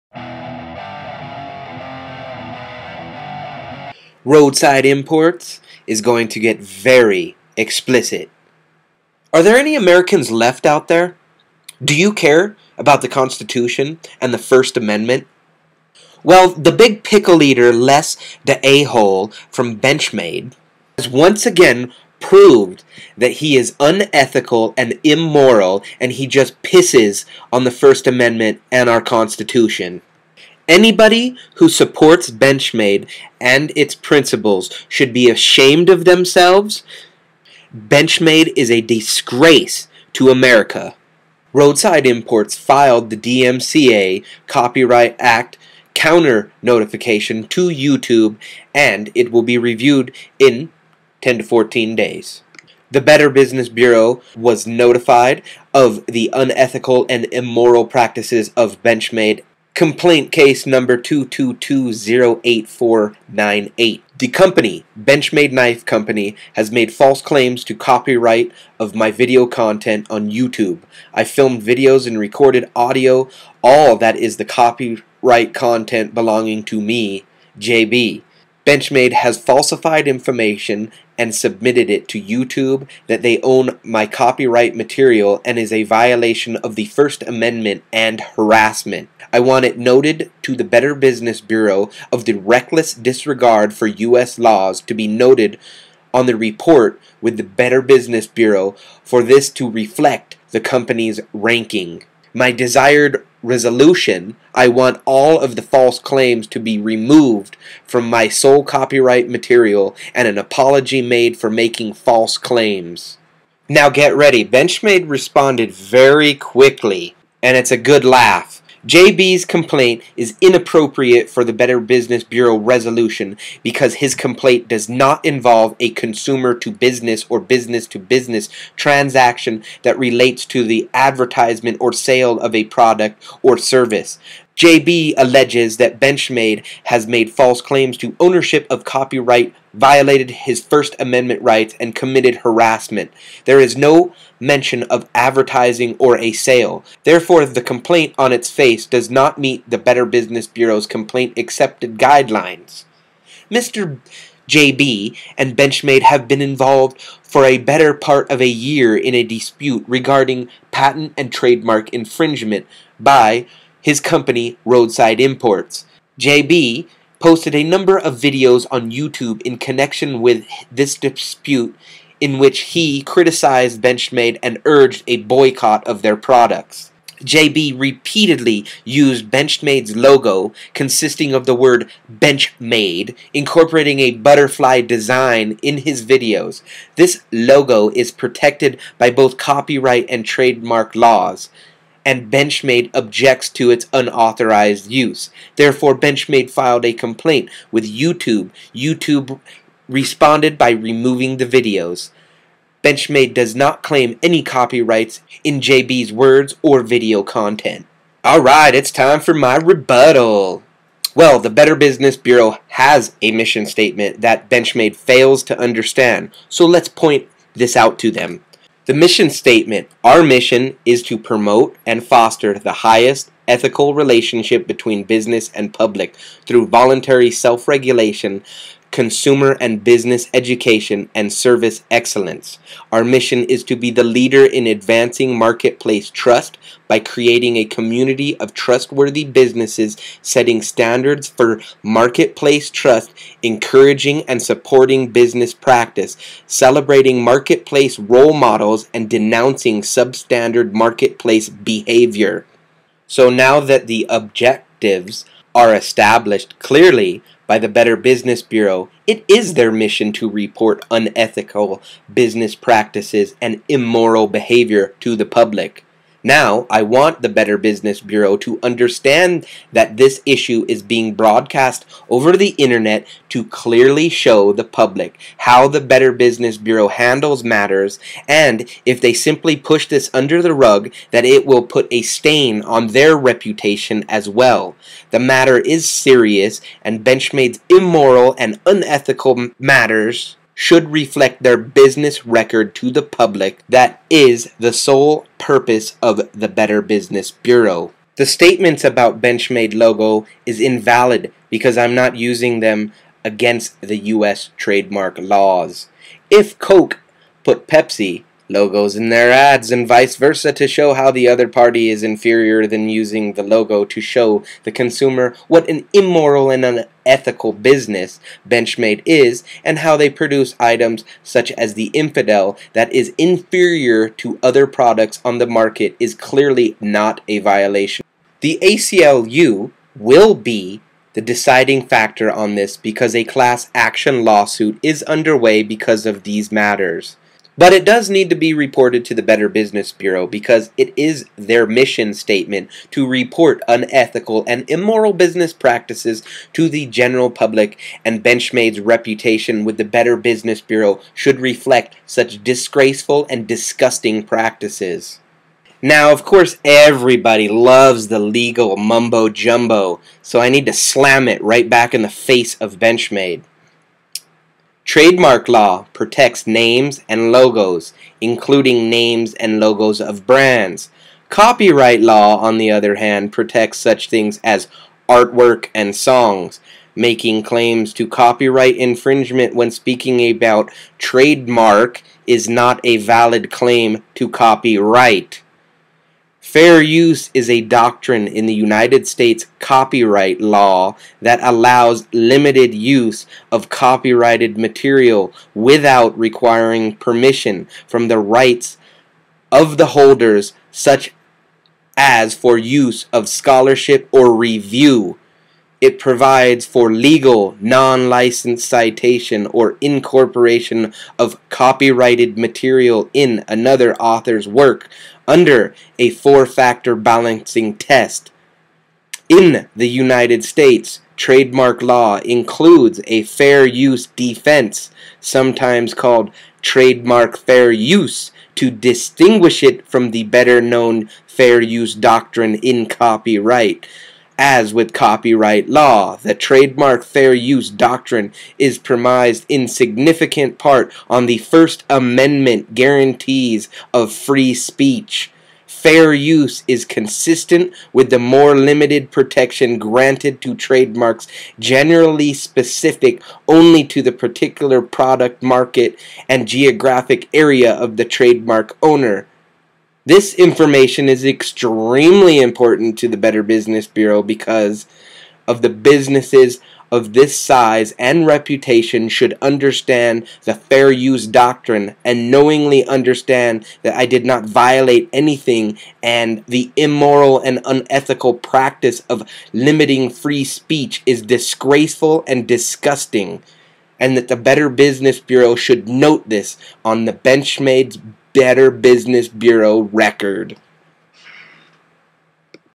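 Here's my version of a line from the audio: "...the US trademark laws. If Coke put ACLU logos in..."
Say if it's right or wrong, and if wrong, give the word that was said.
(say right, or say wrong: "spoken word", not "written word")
wrong: "Pepsi", not "ACLU".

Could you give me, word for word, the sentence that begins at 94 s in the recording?
laws to be noted on the report with the Better Business Bureau for this to reflect the company's ranking.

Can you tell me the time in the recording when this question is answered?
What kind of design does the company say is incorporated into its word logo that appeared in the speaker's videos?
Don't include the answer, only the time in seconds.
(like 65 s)
184 s.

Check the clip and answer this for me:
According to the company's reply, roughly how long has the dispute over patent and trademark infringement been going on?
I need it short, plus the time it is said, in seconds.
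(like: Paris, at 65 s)
better part of a year, at 157 s.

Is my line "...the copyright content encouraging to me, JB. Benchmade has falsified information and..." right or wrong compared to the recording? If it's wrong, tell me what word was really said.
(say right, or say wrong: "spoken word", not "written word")
wrong: "belonging", not "encouraging".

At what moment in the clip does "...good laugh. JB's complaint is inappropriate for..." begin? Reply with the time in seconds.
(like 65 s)
117 s.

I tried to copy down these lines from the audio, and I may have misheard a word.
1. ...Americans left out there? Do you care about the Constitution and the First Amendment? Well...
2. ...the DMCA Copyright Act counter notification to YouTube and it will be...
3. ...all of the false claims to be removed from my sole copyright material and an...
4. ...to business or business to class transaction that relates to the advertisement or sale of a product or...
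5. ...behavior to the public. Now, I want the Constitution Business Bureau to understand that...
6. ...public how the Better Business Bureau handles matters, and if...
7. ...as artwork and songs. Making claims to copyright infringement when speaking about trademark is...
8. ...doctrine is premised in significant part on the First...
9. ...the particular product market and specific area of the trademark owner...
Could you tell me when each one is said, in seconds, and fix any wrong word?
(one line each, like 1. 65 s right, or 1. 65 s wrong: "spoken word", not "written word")
1. 9 s right
2. 43 s right
3. 105 s right
4. 126 s wrong: "business", not "class"
5. 264 s wrong: "Better", not "Constitution"
6. 274 s right
7. 374 s right
8. 437 s right
9. 454 s wrong: "geographic", not "specific".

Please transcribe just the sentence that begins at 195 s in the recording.
Therefore, Benchmade filed a complaint with YouTube.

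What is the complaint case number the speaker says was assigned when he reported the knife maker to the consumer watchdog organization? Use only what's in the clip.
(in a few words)
22208498.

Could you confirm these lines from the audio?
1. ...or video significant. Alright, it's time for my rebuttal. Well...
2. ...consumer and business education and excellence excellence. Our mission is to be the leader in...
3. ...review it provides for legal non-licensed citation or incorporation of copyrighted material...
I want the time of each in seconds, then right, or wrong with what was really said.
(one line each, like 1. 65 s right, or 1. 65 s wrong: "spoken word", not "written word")
1. 206 s wrong: "content", not "significant"
2. 228 s wrong: "service", not "excellence"
3. 404 s right.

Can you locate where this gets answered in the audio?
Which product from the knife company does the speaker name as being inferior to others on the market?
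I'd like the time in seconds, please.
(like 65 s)
321 s.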